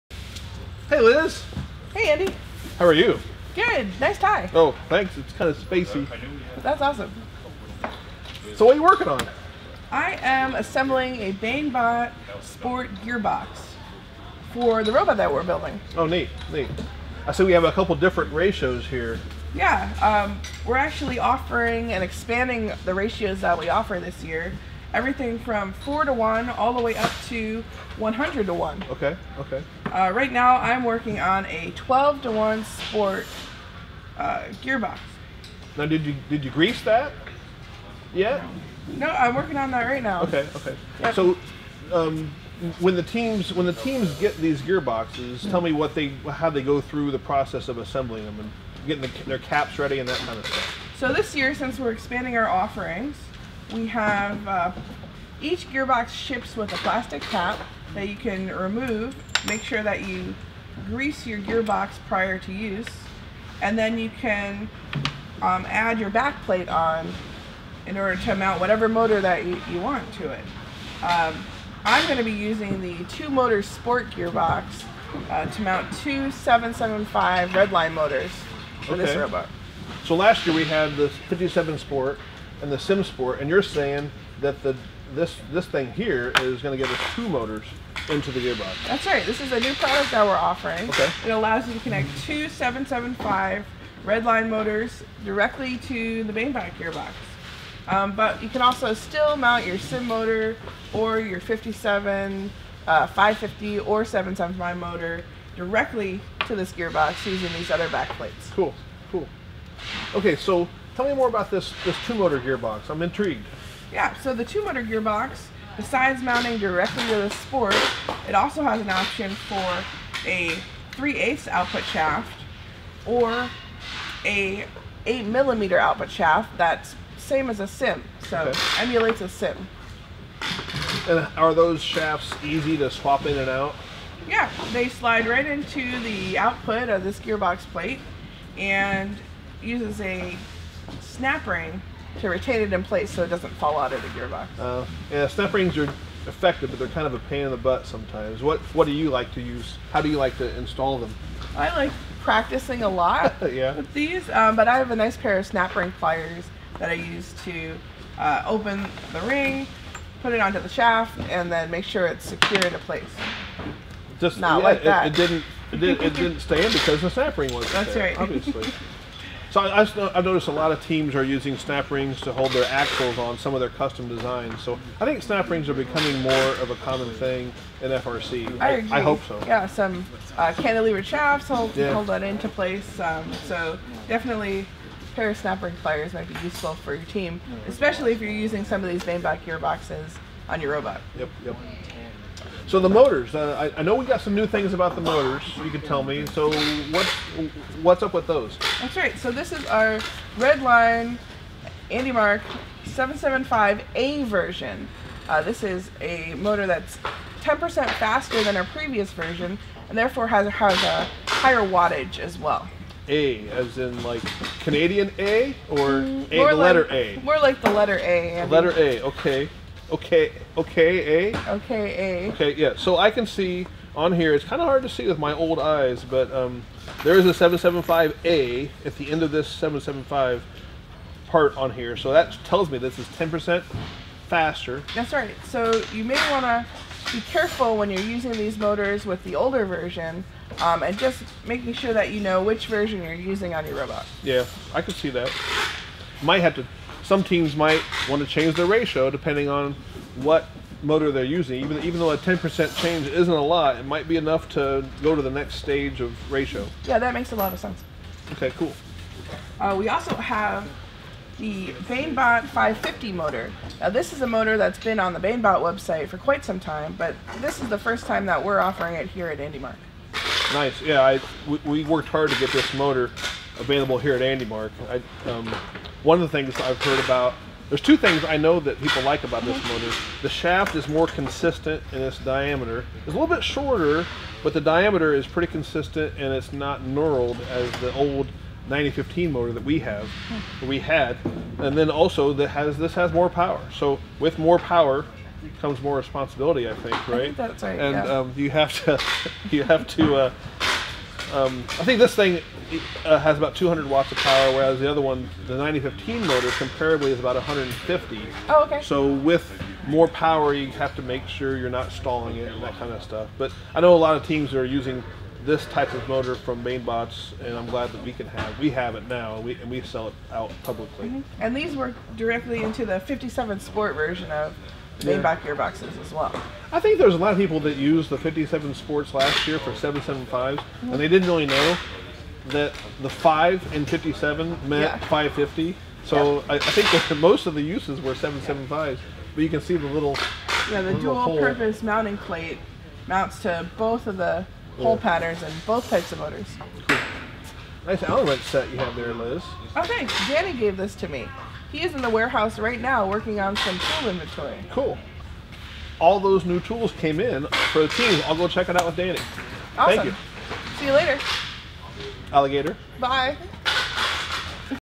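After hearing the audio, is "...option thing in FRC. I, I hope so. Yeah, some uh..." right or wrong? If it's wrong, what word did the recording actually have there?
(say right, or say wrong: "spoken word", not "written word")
wrong: "common", not "option".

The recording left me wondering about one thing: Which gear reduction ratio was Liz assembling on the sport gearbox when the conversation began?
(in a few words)
12 to 1.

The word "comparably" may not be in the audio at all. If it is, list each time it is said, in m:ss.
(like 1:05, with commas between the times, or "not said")
5:06.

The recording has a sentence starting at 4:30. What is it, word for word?
Nice, yeah, I, we, we worked hard to get this motor available here at AndyMark.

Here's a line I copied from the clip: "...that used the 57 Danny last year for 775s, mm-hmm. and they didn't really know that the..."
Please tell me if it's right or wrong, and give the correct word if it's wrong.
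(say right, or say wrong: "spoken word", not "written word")
wrong: "Sports", not "Danny".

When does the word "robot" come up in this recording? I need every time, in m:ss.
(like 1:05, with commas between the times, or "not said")
0:14, 1:19, 3:10, 4:03.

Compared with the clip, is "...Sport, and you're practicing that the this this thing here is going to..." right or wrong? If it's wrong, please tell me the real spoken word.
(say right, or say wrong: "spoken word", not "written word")
wrong: "saying", not "practicing".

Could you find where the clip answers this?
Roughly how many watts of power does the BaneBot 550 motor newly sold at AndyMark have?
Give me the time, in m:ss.
5:03.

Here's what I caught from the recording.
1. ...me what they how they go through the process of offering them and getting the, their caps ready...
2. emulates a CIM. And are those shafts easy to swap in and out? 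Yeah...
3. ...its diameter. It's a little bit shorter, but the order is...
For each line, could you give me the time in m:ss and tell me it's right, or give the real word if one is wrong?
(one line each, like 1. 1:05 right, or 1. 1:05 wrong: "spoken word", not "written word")
1. 0:45 wrong: "assembling", not "offering"
2. 2:08 right
3. 4:42 wrong: "diameter", not "order".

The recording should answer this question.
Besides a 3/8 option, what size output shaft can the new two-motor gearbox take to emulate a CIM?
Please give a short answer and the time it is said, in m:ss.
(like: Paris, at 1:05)
8 millimeter, at 2:05.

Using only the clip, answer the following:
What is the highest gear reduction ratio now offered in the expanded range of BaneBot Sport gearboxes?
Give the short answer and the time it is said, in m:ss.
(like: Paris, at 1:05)
100 to 1, at 0:27.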